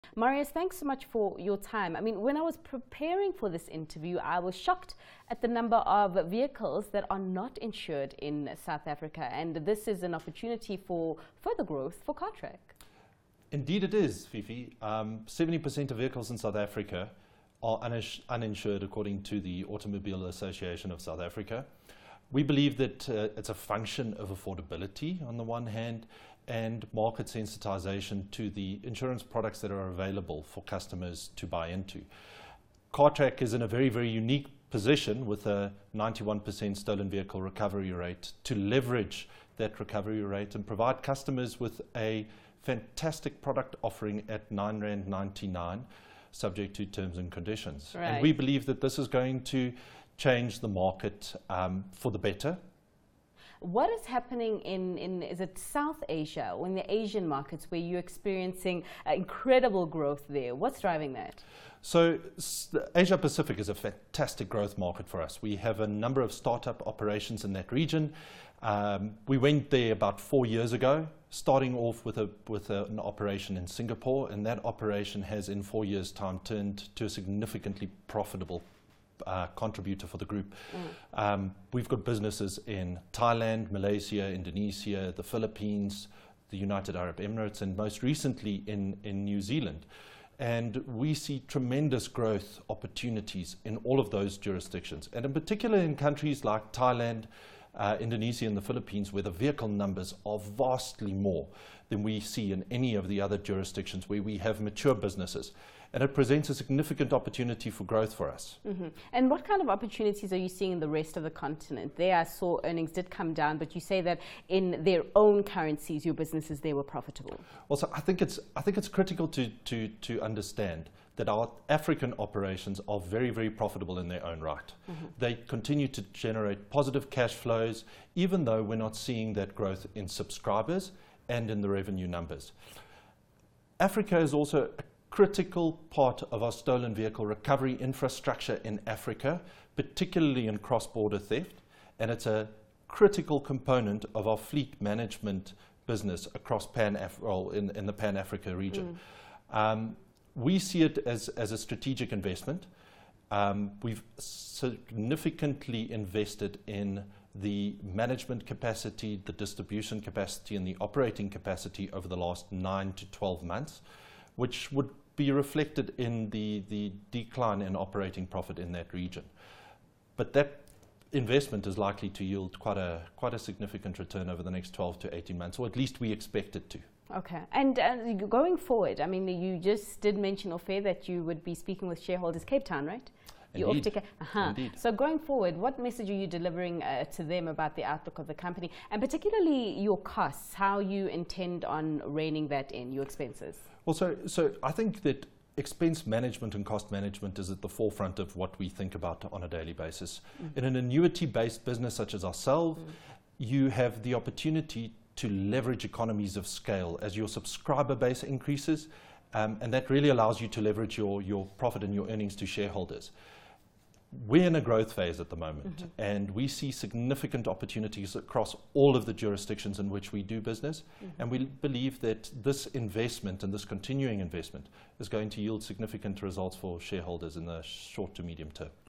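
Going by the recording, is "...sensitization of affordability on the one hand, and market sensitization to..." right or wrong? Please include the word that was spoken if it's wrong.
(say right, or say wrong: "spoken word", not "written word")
wrong: "function", not "sensitization".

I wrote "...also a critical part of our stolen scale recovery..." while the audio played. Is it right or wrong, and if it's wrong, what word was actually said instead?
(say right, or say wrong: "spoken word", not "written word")
wrong: "vehicle", not "scale".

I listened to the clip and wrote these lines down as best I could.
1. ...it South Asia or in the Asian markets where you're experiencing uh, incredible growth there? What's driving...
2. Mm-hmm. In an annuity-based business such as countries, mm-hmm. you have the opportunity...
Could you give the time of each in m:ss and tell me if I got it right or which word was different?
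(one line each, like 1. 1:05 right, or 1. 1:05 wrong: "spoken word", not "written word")
1. 0:55 right
2. 3:20 wrong: "ourselves", not "countries".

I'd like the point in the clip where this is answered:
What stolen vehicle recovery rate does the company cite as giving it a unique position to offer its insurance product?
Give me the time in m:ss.
0:35.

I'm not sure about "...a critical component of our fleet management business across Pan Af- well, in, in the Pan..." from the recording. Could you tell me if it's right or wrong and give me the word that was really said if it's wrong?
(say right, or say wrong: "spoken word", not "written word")
right.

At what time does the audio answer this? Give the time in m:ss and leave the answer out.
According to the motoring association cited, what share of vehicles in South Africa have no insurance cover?
0:14.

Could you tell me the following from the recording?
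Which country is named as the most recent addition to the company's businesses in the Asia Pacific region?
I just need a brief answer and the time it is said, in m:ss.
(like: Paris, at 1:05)
New Zealand, at 1:29.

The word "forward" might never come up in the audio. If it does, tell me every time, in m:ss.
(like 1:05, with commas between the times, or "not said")
2:58, 3:05.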